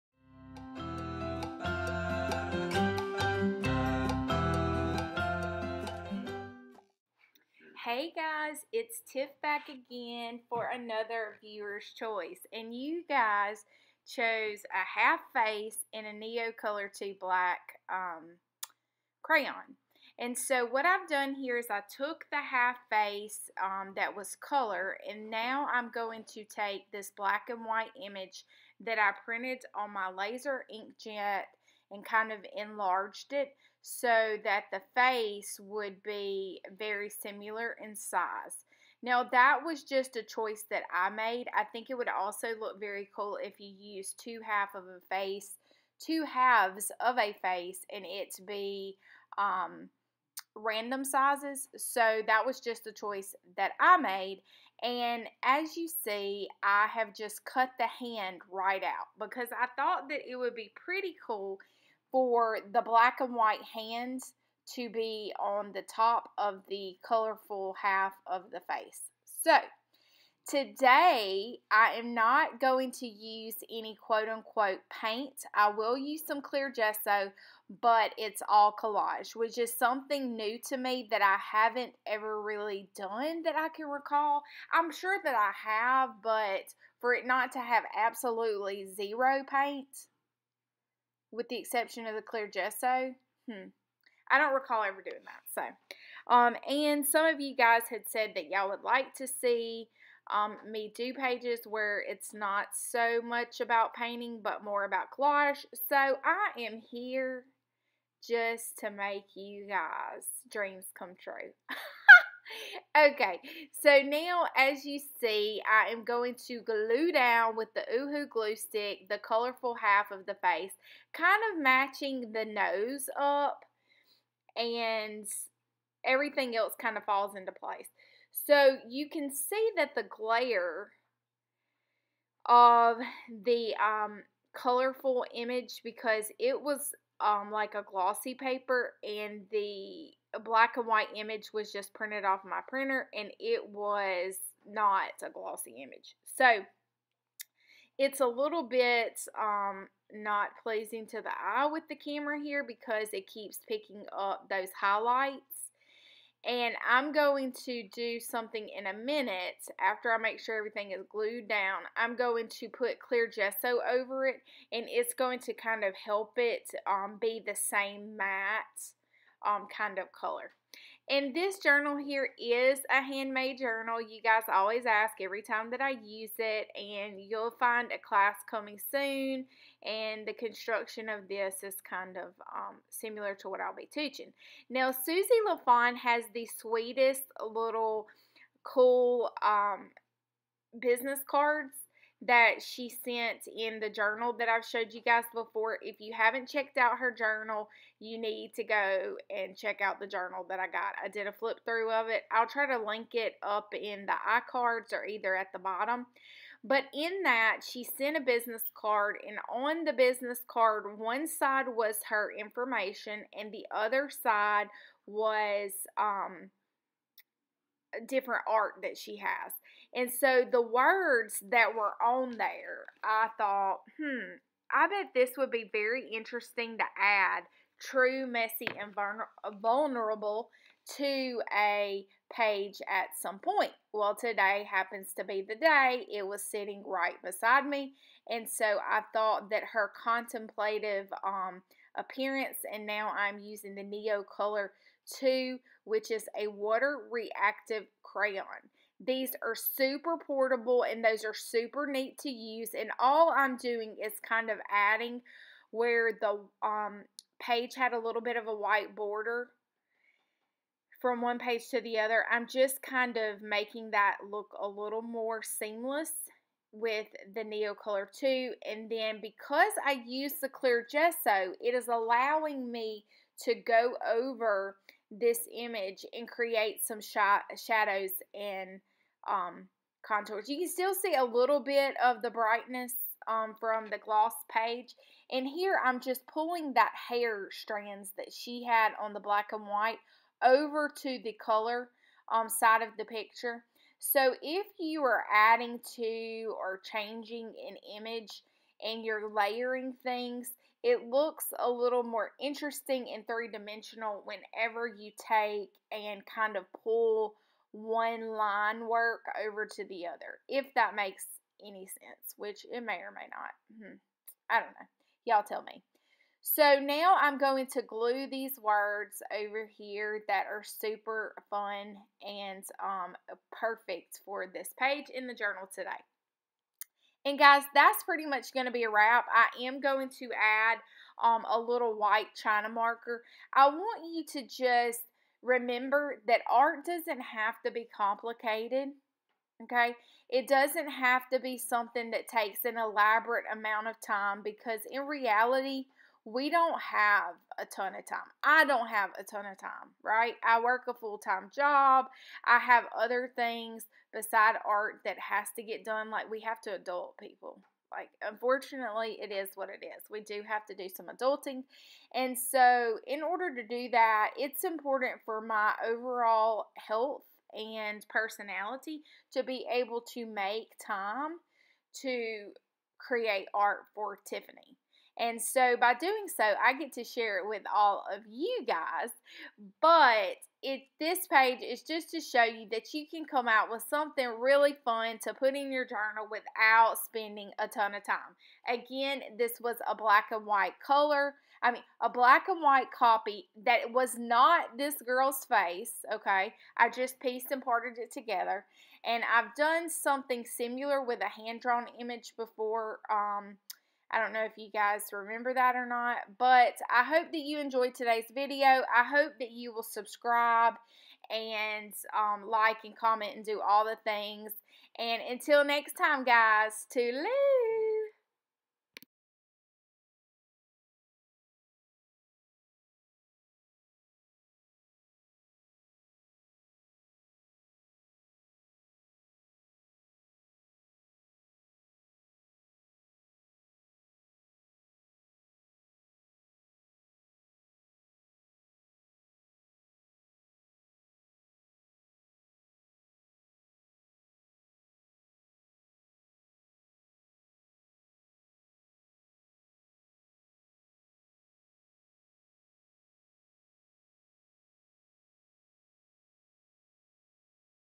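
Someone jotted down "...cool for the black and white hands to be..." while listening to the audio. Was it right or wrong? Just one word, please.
right.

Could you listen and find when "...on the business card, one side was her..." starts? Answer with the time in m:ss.
3:29.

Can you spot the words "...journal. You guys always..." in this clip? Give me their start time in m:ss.
2:53.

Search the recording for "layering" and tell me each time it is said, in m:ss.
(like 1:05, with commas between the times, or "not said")
4:59.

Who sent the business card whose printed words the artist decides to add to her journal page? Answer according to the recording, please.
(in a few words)
Susie LaFon.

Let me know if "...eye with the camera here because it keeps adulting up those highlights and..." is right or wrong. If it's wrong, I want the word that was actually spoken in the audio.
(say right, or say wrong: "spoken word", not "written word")
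wrong: "picking", not "adulting".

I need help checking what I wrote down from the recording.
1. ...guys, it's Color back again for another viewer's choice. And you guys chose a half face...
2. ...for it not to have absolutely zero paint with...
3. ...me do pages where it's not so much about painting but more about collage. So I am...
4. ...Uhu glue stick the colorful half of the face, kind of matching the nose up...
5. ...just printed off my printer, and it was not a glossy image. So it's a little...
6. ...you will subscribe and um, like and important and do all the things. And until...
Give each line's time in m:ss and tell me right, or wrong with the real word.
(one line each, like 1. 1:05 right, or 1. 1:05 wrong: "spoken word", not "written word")
1. 0:08 wrong: "Tiff", not "Color"
2. 1:26 right
3. 1:40 right
4. 1:57 right
5. 2:21 right
6. 6:49 wrong: "comment", not "important".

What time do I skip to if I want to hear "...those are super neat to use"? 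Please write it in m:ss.
4:11.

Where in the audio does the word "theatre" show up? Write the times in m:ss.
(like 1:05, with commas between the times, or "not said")
not said.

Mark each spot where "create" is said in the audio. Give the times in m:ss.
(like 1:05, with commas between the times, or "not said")
4:36, 6:12.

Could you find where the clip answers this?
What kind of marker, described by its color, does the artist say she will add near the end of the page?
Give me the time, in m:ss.
5:31.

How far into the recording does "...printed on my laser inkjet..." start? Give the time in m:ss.
0:29.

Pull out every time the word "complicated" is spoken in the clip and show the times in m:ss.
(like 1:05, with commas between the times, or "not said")
5:37.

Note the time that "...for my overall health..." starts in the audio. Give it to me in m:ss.
6:05.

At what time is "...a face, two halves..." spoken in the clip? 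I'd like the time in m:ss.
0:44.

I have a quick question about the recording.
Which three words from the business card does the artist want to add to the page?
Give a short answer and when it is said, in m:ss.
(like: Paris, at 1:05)
true, messy, and vulnerable, at 3:47.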